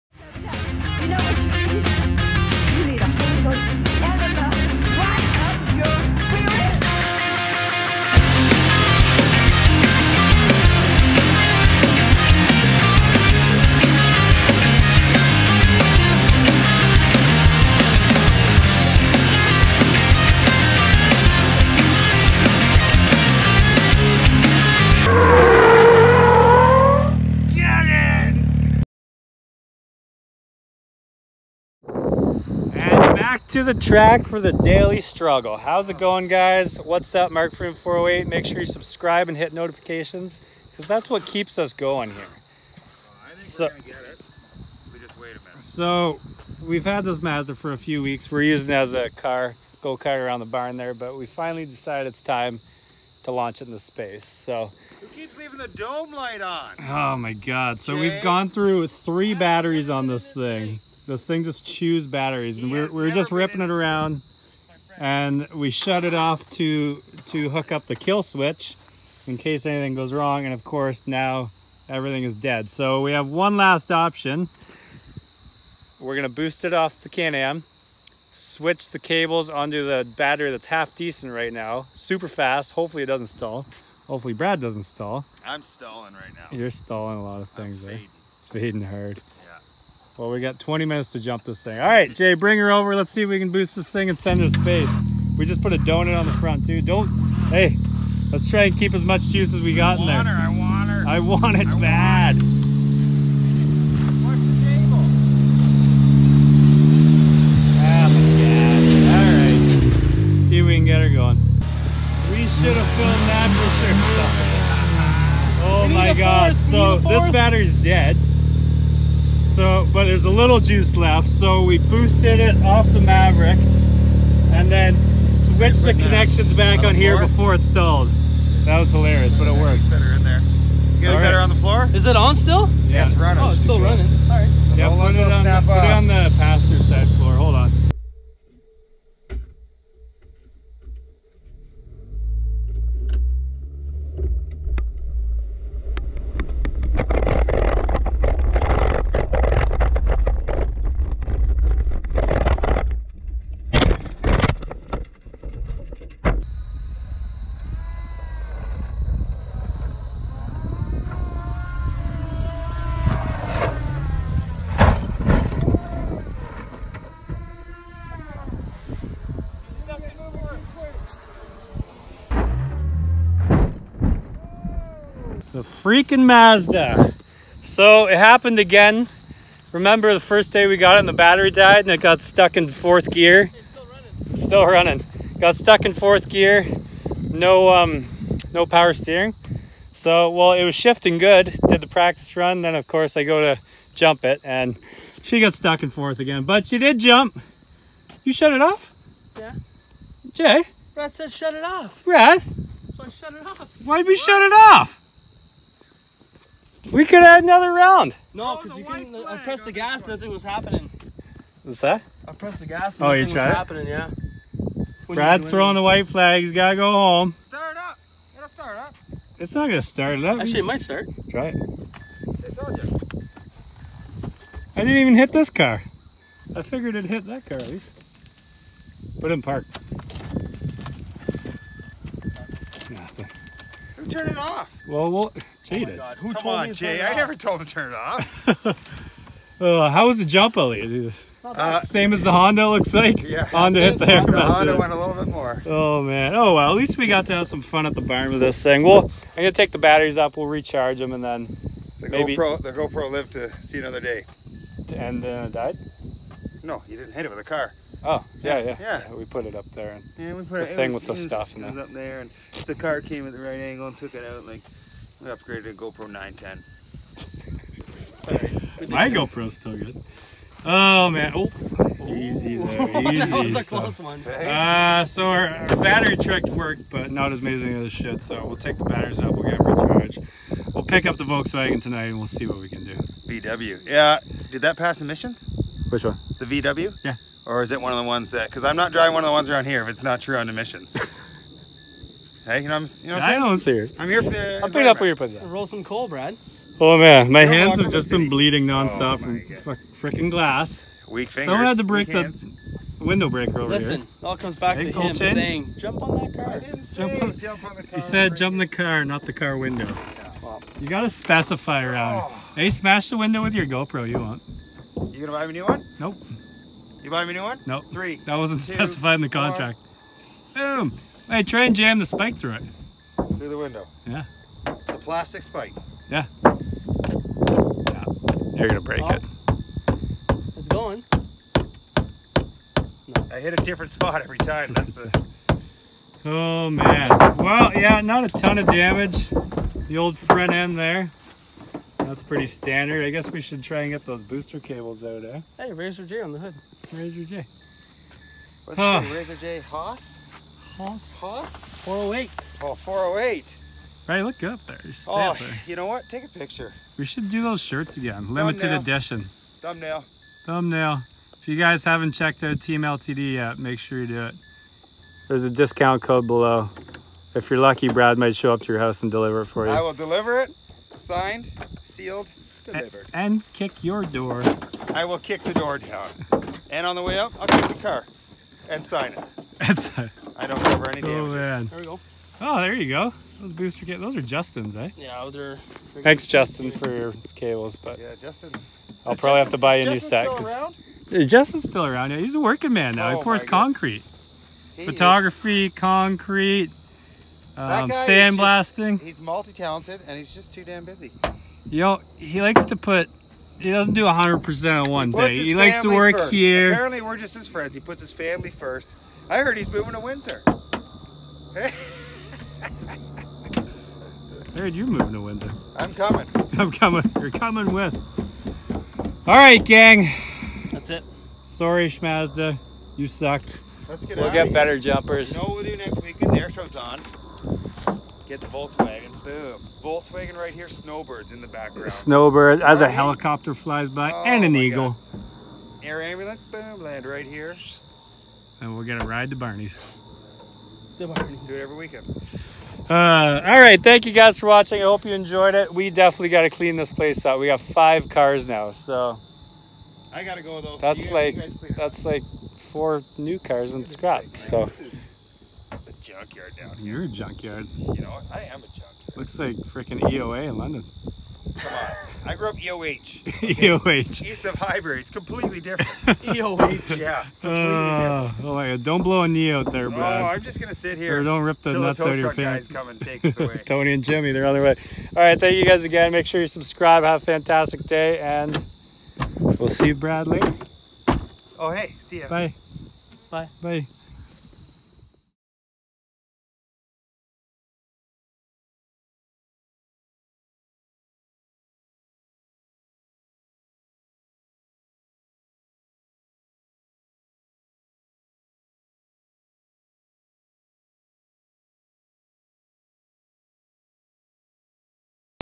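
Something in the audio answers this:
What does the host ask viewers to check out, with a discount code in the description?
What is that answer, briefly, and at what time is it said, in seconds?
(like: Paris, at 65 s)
Team LTD, at 362 s.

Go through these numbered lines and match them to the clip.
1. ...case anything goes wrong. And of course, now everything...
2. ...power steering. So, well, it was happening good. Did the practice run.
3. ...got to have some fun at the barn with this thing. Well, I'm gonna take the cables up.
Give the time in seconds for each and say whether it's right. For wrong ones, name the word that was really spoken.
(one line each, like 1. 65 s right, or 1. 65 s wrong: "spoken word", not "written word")
1. 69 s right
2. 188 s wrong: "shifting", not "happening"
3. 247 s wrong: "batteries", not "cables".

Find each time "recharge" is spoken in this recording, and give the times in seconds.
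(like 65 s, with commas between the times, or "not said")
250 s, 279 s.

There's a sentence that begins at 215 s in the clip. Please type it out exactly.
When Brad's throwing the white flag.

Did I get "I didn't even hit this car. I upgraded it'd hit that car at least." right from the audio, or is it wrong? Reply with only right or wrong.
wrong.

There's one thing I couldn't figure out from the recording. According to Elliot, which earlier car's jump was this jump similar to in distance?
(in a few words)
The Honda.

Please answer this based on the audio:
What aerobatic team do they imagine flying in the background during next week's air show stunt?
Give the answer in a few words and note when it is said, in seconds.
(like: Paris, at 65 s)
Snowbirds, at 430 s.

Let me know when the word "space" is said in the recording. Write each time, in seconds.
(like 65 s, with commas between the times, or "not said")
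53 s, 94 s.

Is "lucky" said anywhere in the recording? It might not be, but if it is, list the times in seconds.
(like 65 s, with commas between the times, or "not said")
367 s.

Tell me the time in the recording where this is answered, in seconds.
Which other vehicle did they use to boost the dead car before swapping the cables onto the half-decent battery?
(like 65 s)
77 s.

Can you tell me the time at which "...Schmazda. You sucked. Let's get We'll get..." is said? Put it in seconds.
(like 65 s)
421 s.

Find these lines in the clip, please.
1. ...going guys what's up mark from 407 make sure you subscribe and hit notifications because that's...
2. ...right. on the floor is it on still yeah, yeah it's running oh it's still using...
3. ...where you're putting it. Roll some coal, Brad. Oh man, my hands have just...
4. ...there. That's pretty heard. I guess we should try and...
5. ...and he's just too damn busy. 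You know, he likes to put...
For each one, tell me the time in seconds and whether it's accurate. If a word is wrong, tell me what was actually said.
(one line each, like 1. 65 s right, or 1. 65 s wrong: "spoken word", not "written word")
1. 35 s wrong: "408", not "407"
2. 131 s wrong: "running", not "using"
3. 294 s right
4. 340 s wrong: "standard", not "heard"
5. 400 s right.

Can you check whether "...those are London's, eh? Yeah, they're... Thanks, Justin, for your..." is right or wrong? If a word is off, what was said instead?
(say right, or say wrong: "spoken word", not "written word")
wrong: "Justin", not "London".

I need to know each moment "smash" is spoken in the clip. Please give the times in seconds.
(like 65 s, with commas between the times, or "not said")
312 s.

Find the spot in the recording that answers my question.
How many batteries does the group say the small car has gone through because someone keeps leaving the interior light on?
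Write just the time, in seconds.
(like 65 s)
58 s.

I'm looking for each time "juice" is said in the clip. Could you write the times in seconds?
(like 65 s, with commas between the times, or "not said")
99 s, 120 s.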